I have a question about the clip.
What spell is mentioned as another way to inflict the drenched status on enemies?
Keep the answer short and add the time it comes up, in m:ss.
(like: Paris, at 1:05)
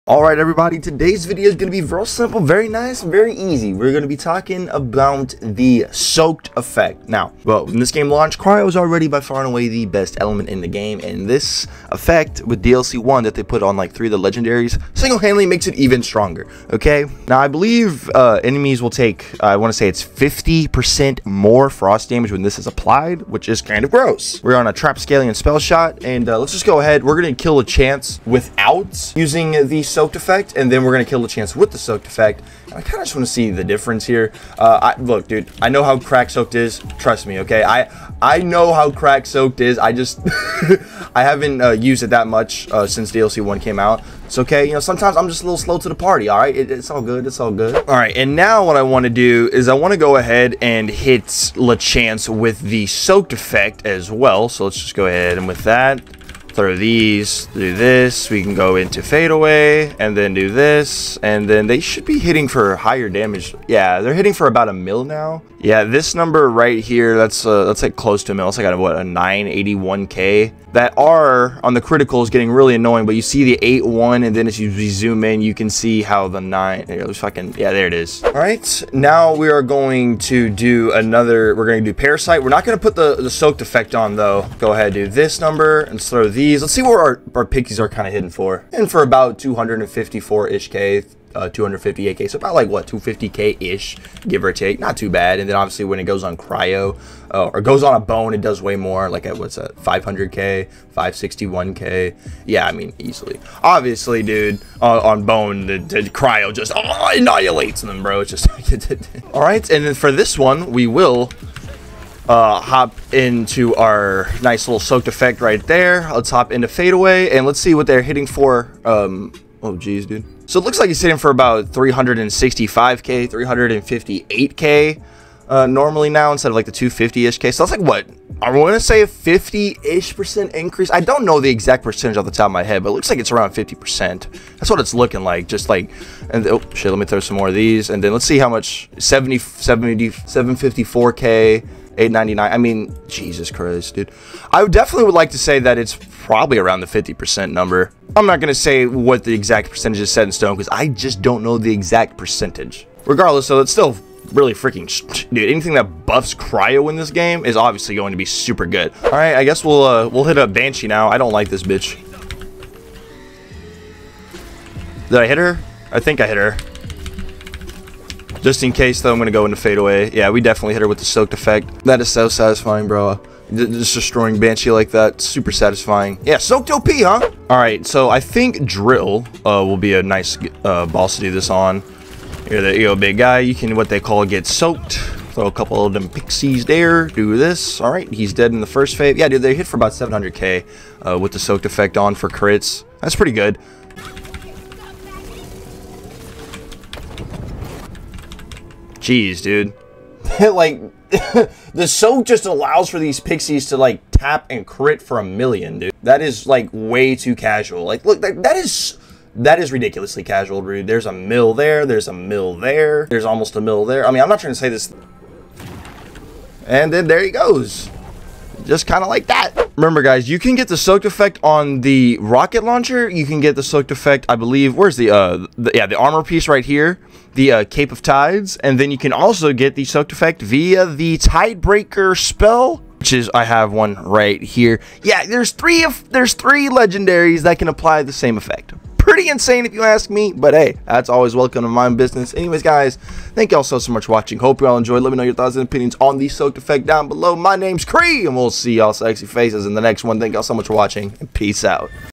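Tidebreaker, at 3:51.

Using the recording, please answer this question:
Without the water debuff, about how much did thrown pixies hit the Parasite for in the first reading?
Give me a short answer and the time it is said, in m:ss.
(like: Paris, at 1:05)
254K, at 1:29.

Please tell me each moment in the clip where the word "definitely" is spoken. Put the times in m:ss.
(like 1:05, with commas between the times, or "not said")
2:24, 2:50.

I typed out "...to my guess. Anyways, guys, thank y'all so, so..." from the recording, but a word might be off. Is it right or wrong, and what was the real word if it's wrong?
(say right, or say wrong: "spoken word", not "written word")
wrong: "business", not "guess".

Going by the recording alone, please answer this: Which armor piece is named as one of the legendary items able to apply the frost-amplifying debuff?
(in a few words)
Cape of Tides.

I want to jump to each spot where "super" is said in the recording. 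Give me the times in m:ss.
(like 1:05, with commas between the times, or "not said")
2:38, 2:55.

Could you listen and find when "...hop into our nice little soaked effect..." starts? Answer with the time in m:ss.
1:52.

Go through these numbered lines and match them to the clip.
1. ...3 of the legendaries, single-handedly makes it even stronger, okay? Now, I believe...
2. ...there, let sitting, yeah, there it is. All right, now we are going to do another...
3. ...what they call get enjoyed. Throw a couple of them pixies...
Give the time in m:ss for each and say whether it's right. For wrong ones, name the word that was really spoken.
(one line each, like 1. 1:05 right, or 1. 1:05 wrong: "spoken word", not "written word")
1. 0:13 right
2. 1:16 wrong: "fucking", not "sitting"
3. 3:03 wrong: "soaked", not "enjoyed".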